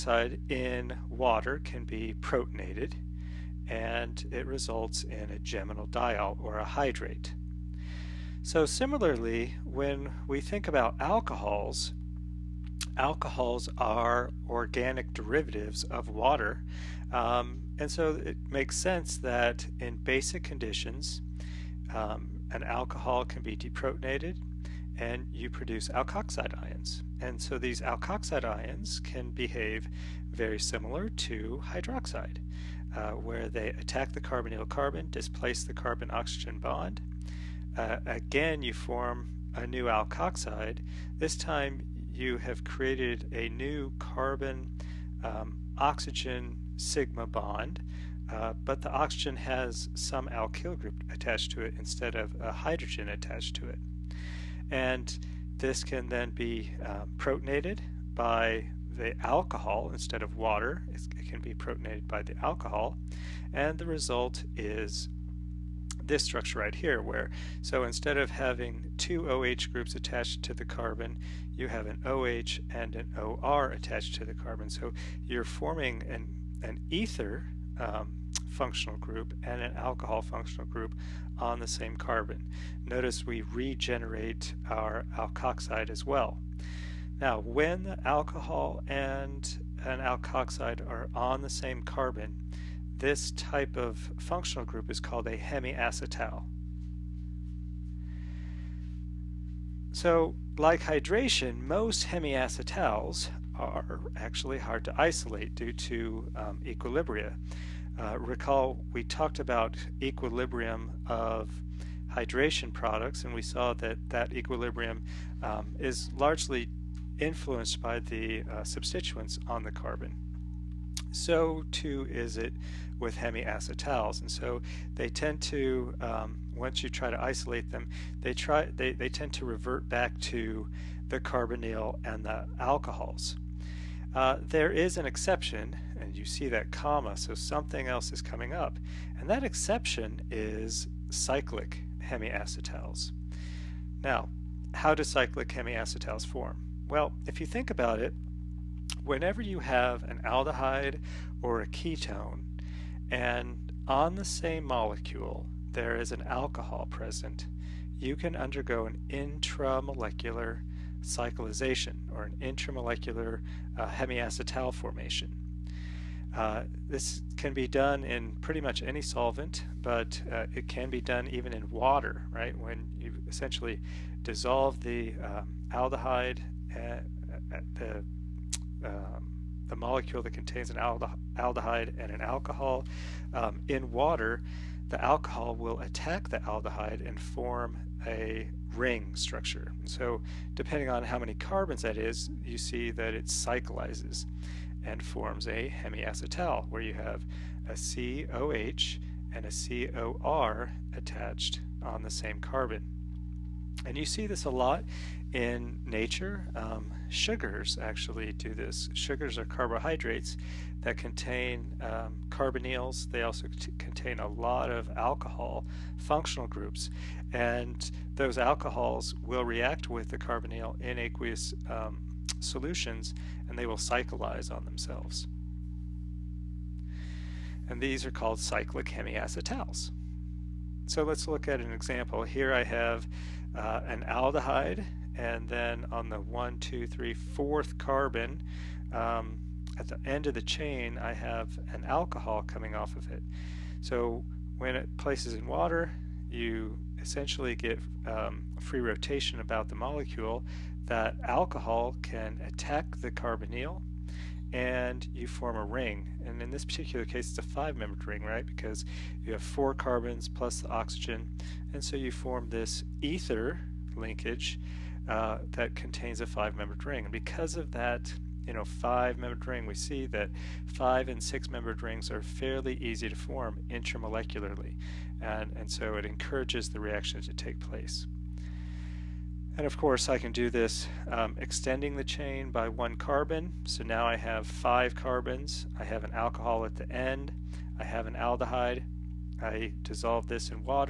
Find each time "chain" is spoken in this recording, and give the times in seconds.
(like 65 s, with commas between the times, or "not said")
240 s, 282 s.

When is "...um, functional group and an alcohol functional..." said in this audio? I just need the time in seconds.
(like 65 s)
77 s.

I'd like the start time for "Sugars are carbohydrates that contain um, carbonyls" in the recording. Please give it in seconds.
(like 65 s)
208 s.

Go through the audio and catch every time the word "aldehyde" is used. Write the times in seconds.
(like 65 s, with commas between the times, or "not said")
150 s, 175 s, 180 s, 186 s, 234 s, 288 s.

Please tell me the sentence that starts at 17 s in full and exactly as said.
Um, and so it makes sense that in basic conditions, um, an alcohol can be deprotonated and you produce alkoxide ions.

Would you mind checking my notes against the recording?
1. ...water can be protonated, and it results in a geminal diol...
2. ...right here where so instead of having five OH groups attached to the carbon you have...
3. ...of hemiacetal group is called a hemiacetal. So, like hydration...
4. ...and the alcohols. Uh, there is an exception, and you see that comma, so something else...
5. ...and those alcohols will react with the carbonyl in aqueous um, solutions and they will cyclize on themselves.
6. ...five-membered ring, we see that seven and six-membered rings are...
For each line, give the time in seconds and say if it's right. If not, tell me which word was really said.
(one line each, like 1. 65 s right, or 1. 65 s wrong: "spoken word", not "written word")
1. 1 s right
2. 66 s wrong: "two", not "five"
3. 93 s wrong: "functional", not "hemiacetal"
4. 132 s right
5. 217 s right
6. 268 s wrong: "five", not "seven".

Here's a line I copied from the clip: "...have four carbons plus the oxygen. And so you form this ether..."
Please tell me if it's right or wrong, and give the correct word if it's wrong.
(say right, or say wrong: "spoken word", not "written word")
right.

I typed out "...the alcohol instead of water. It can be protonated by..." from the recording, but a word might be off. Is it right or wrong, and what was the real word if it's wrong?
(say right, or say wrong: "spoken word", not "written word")
right.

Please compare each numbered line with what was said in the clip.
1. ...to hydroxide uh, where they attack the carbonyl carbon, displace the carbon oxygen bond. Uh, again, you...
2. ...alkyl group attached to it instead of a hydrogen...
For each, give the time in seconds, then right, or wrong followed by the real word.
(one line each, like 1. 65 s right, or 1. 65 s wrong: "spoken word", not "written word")
1. 31 s right
2. 50 s right.